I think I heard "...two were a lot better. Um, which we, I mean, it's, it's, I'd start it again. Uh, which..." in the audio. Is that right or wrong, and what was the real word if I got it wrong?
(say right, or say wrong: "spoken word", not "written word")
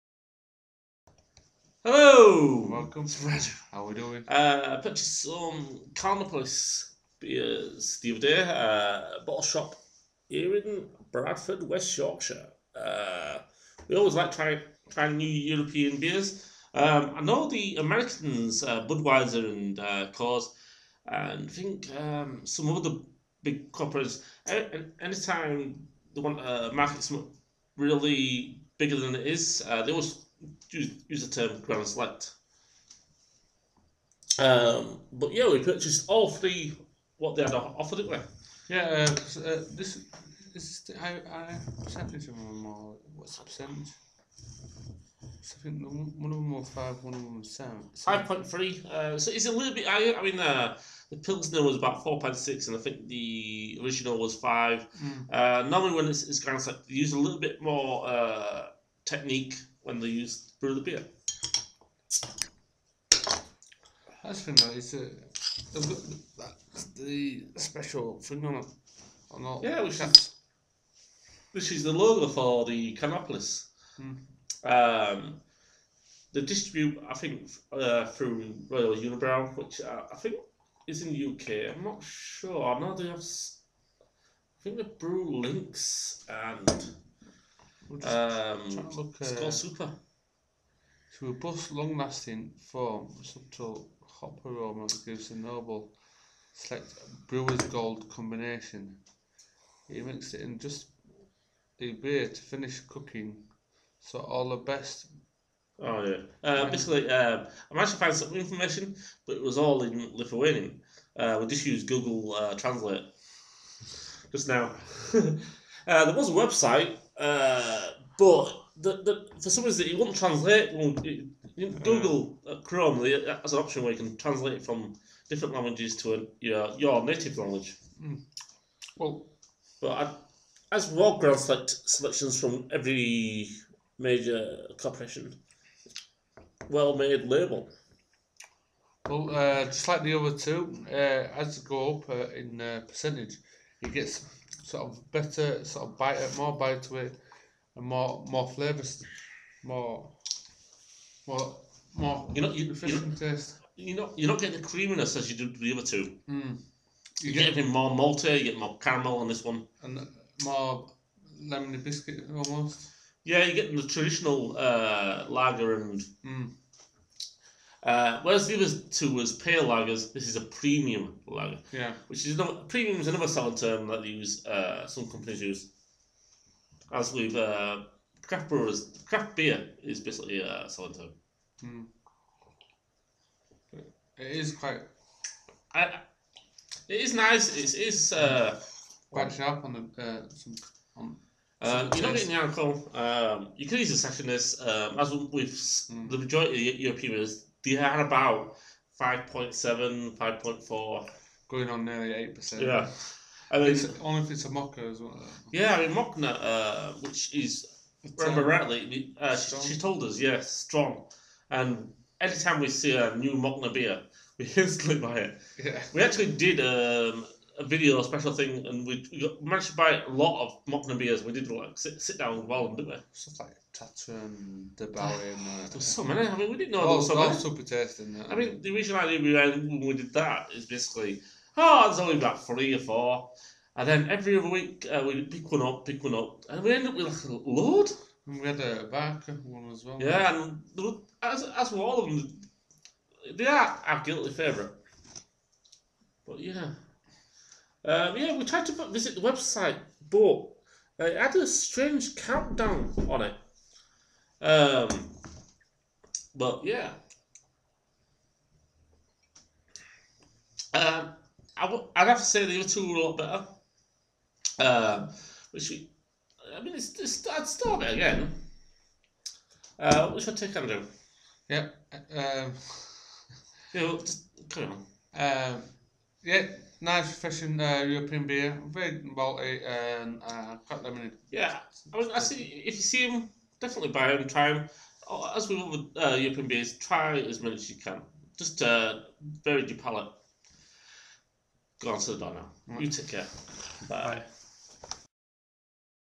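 right.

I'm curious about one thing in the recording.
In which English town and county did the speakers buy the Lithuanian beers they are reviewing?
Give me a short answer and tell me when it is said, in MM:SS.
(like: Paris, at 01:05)
Bradford, West Yorkshire, at 00:11.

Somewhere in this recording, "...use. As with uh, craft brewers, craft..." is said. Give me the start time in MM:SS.
02:55.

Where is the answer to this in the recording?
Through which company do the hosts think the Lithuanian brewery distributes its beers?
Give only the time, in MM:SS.
01:18.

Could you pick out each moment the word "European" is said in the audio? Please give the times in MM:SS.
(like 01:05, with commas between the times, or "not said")
00:15, 03:16, 04:37, 04:46.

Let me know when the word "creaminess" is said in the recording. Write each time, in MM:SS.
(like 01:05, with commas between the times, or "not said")
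02:34.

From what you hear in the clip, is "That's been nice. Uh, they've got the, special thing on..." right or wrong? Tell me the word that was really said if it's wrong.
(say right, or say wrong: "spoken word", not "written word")
right.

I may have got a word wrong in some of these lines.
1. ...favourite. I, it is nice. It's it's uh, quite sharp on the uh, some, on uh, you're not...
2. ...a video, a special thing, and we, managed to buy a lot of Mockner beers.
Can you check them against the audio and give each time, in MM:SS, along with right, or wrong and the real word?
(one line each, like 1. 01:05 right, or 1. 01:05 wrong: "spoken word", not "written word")
1. 03:04 wrong: "quite", not "favourite"
2. 03:37 right.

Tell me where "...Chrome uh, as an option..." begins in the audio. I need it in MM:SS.
02:02.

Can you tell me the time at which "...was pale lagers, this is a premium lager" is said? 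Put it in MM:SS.
02:49.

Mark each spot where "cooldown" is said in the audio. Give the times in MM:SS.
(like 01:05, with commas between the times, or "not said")
not said.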